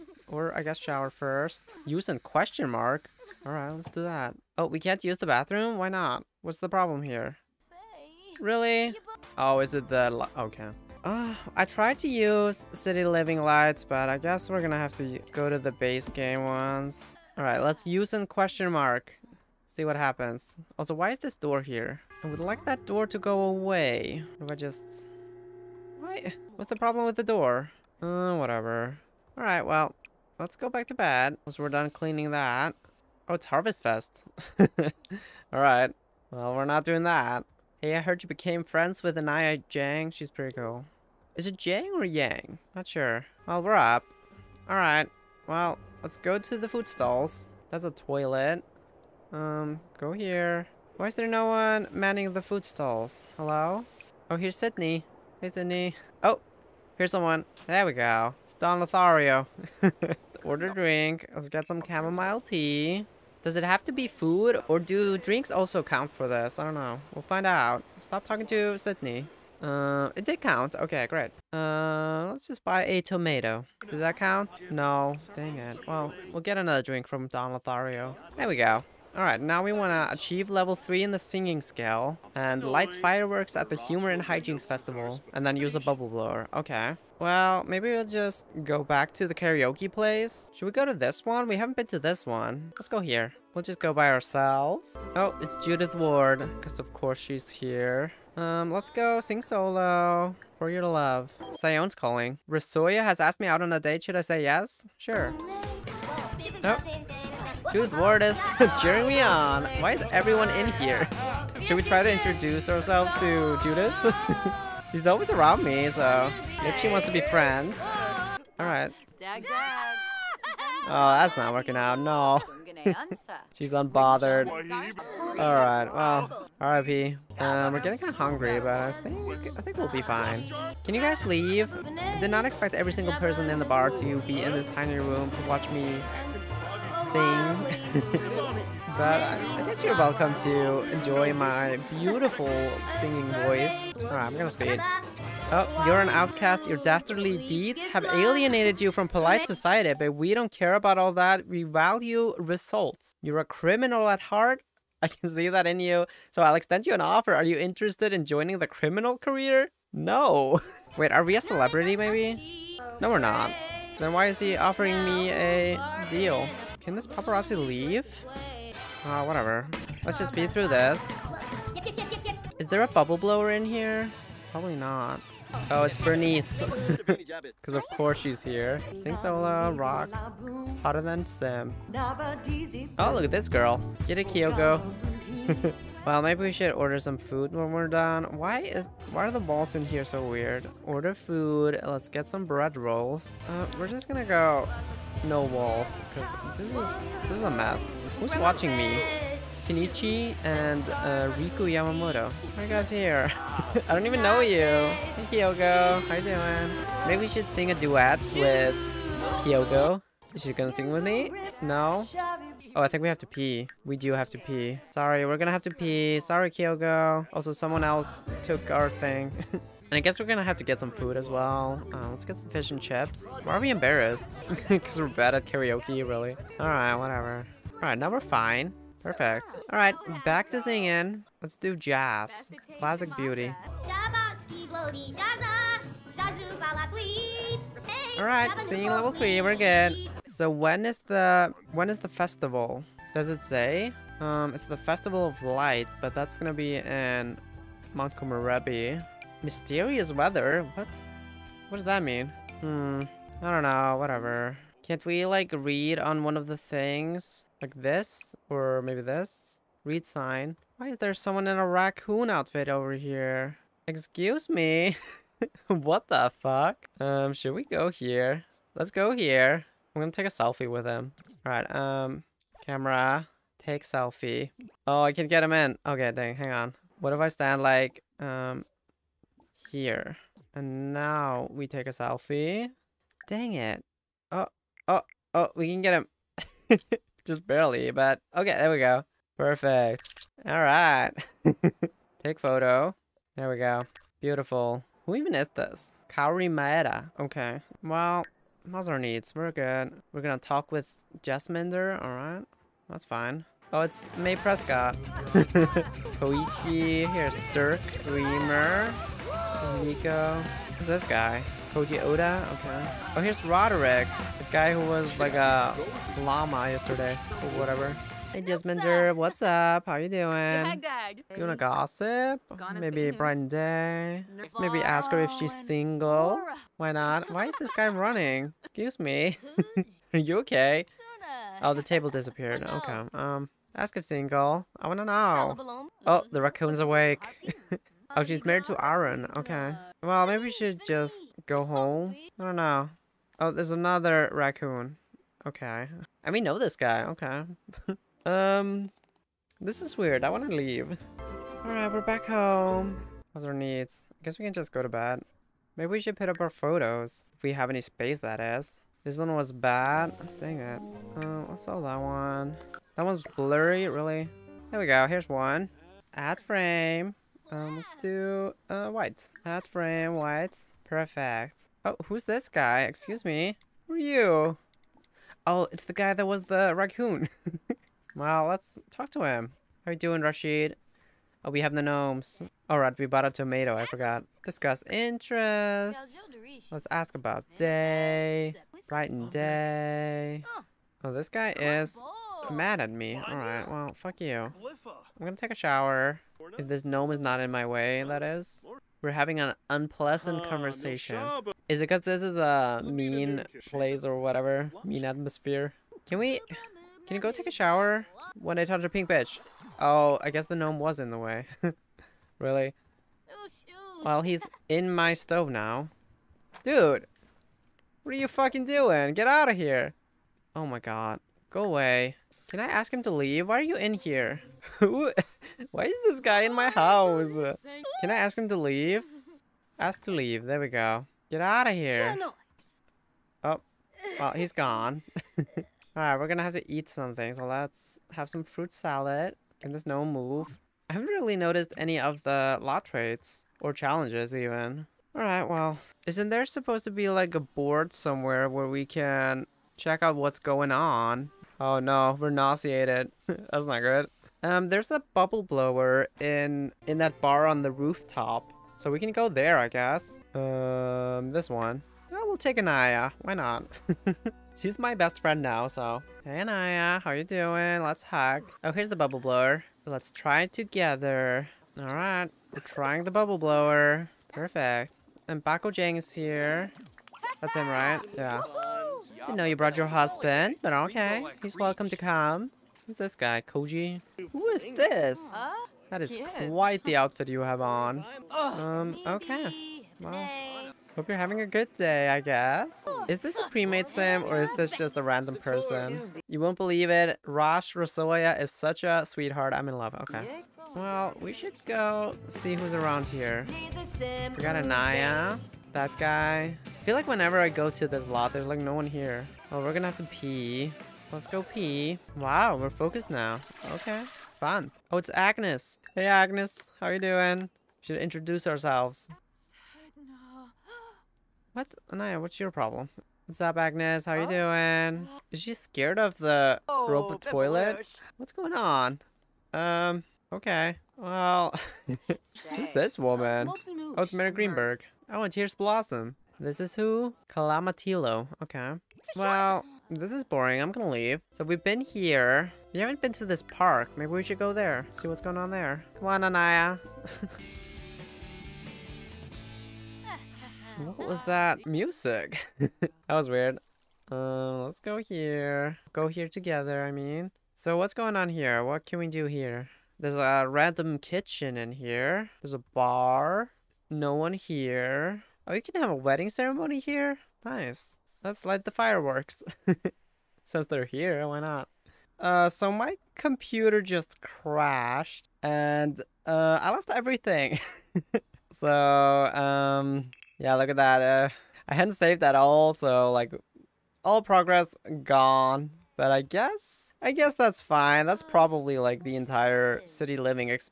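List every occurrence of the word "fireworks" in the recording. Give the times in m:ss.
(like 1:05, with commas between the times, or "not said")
1:22, 9:28.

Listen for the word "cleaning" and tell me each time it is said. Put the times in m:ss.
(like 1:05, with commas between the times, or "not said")
0:31.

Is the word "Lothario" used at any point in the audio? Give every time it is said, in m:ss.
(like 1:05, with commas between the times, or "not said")
0:58, 1:17.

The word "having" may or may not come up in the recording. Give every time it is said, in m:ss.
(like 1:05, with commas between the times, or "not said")
6:39, 8:11.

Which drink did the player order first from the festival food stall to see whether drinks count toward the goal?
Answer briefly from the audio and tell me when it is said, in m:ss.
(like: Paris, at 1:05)
Chamomile tea, at 1:01.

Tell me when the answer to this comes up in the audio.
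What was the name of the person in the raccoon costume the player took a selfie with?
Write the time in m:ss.
4:56.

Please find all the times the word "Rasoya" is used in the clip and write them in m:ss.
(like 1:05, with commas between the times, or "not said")
1:42, 8:17.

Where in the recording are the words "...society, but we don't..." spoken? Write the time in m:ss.
2:29.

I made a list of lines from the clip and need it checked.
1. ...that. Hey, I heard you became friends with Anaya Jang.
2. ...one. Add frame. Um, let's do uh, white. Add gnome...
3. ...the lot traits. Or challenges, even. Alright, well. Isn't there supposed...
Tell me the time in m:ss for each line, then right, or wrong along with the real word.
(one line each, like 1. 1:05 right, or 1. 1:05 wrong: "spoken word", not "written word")
1. 0:37 right
2. 6:05 wrong: "frame", not "gnome"
3. 7:22 right.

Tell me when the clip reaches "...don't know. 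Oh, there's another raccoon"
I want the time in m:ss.
5:42.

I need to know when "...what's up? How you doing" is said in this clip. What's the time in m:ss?
5:19.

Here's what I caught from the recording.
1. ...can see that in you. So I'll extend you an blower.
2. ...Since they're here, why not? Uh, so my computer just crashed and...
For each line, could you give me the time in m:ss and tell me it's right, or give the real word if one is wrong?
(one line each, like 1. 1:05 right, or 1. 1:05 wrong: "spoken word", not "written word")
1. 2:35 wrong: "offer", not "blower"
2. 9:30 right.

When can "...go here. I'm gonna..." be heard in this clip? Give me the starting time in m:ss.
4:28.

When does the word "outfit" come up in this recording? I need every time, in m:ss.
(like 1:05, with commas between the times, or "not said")
4:22, 8:06.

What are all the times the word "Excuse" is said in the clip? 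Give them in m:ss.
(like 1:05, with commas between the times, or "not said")
4:23, 5:28, 6:12.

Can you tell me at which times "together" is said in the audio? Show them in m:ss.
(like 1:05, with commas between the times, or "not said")
7:50, 9:16.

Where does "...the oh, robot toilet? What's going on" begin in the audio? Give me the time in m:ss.
8:46.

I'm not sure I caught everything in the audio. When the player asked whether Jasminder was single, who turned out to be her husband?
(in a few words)
Aaron.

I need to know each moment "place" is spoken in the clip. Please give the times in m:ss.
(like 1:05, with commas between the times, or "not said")
1:29, 6:43.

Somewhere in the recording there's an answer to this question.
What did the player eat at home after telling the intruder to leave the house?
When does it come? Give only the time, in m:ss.
7:18.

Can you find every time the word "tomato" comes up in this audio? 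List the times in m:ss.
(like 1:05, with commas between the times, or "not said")
1:13, 6:23.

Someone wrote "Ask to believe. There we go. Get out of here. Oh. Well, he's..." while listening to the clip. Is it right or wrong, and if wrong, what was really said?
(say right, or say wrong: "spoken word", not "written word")
wrong: "leave", not "believe".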